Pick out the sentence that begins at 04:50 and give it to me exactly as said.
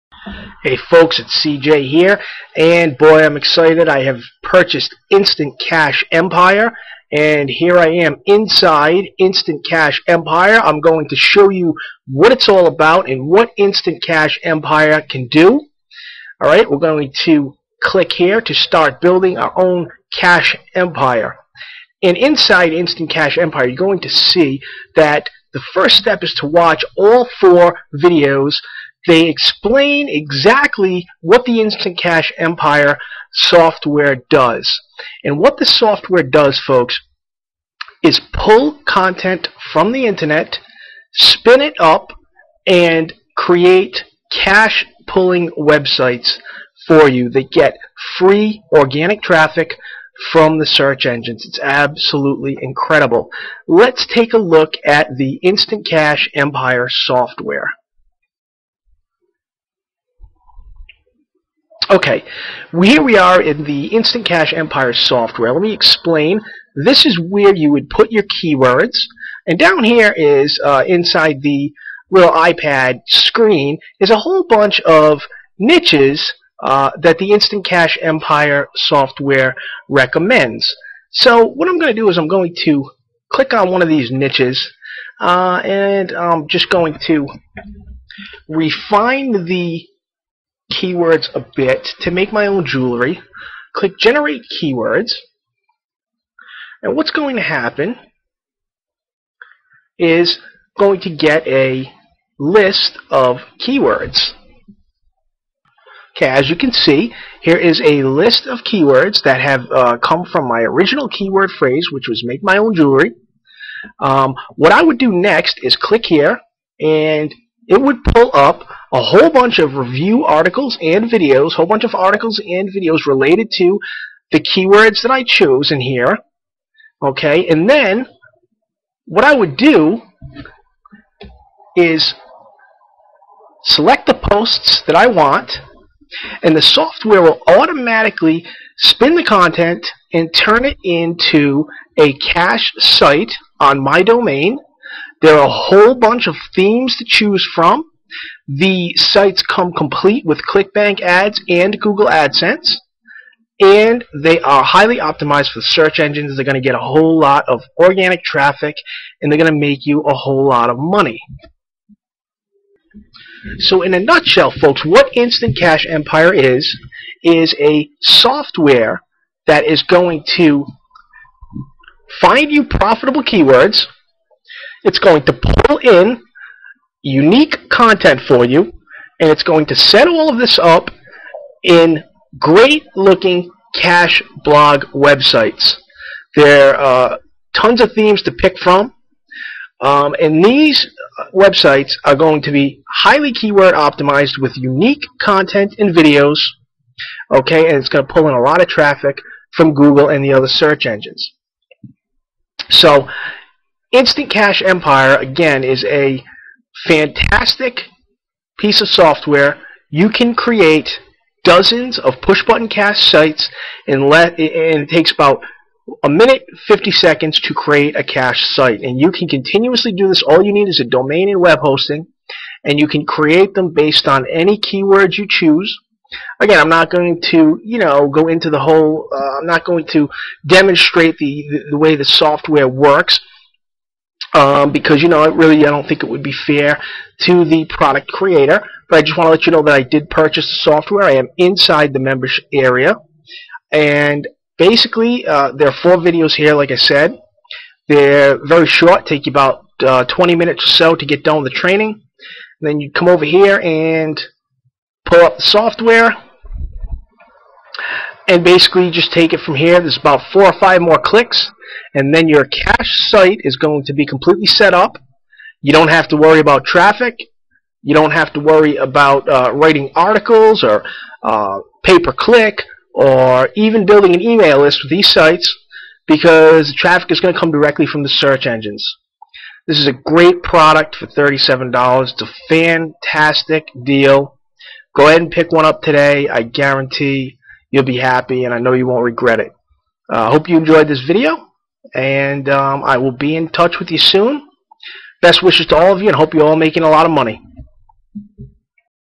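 I uh, hope you enjoyed this video, and um, I will be in touch with you soon.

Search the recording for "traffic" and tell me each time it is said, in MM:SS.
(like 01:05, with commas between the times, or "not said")
00:49, 02:38, 03:18, 04:26, 04:36.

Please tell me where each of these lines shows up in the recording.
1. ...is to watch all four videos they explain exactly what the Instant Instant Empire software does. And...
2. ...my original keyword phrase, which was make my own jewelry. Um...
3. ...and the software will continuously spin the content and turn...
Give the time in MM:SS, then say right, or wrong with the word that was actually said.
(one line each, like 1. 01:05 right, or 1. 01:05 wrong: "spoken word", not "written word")
1. 00:26 wrong: "Cash", not "Instant"
2. 01:50 right
3. 02:16 wrong: "automatically", not "continuously".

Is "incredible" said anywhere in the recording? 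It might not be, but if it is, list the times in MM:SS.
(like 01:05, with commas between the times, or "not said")
00:52.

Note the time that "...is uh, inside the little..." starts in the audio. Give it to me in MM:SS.
01:10.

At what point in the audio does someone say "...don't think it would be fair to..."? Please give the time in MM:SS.
03:55.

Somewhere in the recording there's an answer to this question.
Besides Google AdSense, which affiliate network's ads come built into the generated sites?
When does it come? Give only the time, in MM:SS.
02:30.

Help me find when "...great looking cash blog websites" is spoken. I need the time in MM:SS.
03:02.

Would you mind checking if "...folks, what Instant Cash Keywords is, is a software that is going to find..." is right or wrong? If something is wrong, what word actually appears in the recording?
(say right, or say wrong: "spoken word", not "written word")
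wrong: "Empire", not "Keywords".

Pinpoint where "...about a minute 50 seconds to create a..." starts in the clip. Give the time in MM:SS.
03:35.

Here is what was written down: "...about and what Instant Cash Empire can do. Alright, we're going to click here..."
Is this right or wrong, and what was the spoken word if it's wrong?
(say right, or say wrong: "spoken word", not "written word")
right.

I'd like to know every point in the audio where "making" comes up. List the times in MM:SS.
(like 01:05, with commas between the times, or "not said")
04:56.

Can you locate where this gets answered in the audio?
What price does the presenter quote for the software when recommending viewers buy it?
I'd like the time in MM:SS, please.
04:41.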